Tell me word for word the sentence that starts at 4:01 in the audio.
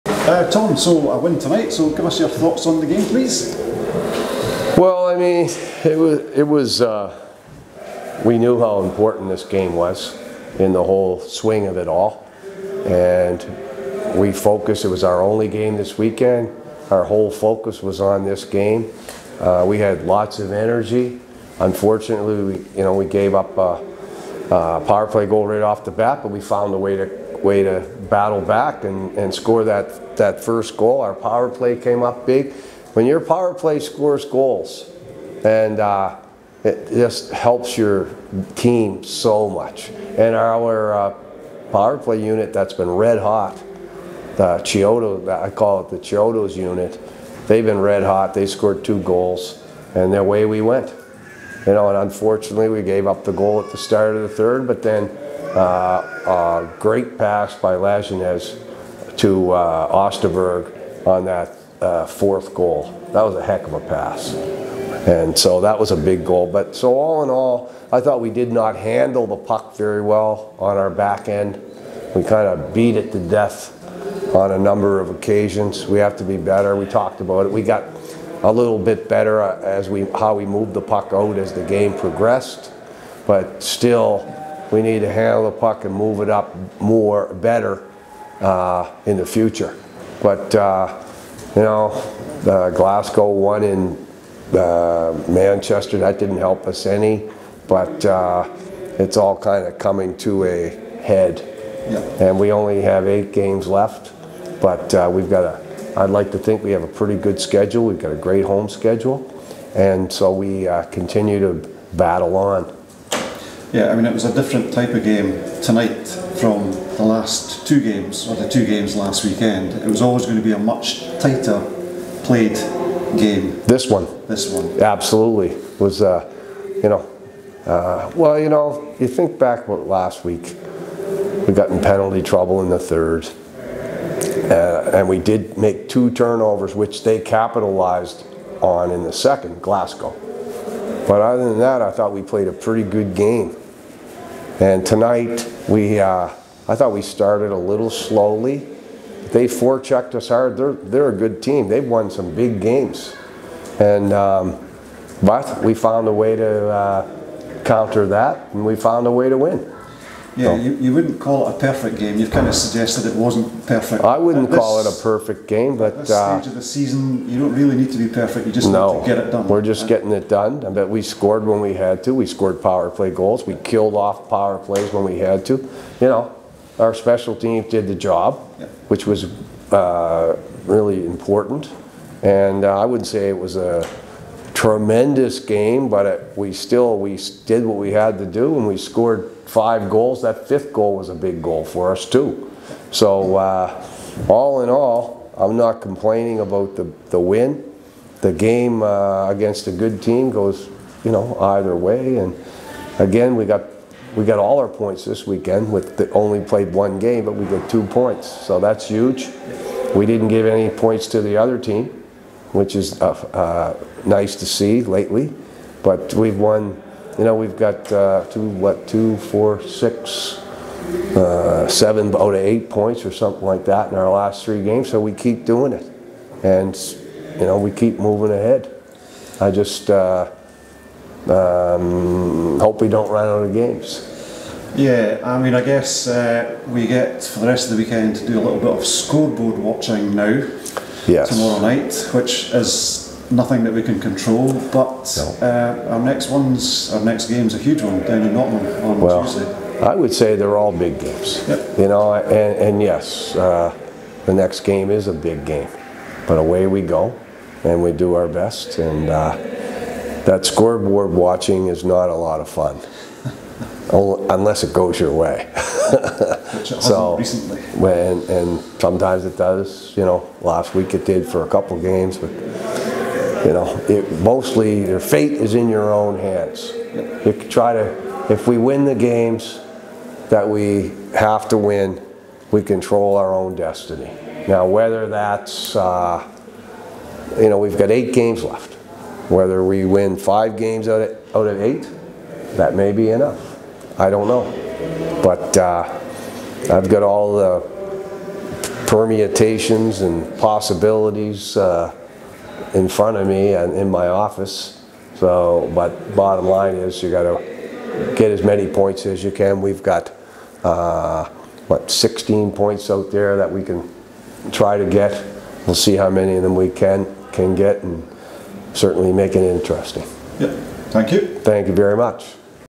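tomorrow night, which is nothing that we can control.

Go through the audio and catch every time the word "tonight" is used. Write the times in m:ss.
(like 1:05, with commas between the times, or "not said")
0:01, 1:55, 2:24.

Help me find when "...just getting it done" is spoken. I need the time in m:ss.
2:49.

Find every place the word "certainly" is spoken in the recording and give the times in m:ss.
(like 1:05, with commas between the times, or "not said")
5:18.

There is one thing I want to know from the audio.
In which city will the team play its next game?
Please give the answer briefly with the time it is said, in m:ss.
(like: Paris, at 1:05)
Nottingham, at 4:08.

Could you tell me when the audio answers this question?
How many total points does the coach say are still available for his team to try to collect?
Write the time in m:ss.
5:11.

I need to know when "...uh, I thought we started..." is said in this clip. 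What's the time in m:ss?
2:25.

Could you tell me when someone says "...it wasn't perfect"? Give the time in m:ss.
2:43.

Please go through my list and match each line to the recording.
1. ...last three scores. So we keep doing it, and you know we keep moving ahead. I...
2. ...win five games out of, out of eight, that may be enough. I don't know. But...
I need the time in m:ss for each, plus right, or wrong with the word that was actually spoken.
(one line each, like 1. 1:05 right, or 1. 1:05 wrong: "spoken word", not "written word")
1. 3:44 wrong: "games", not "scores"
2. 4:49 right.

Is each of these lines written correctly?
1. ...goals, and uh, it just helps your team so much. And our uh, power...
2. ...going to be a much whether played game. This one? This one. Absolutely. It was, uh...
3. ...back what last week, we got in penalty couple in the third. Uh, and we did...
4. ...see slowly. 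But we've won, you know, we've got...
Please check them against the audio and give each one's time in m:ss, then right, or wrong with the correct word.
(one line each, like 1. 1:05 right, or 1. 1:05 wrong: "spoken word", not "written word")
1. 0:34 right
2. 2:00 wrong: "tighter", not "whether"
3. 2:09 wrong: "trouble", not "couple"
4. 3:34 wrong: "lately", not "slowly".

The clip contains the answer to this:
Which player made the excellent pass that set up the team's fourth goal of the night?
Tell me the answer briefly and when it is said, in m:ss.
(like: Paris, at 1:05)
Lajeunesse, at 0:57.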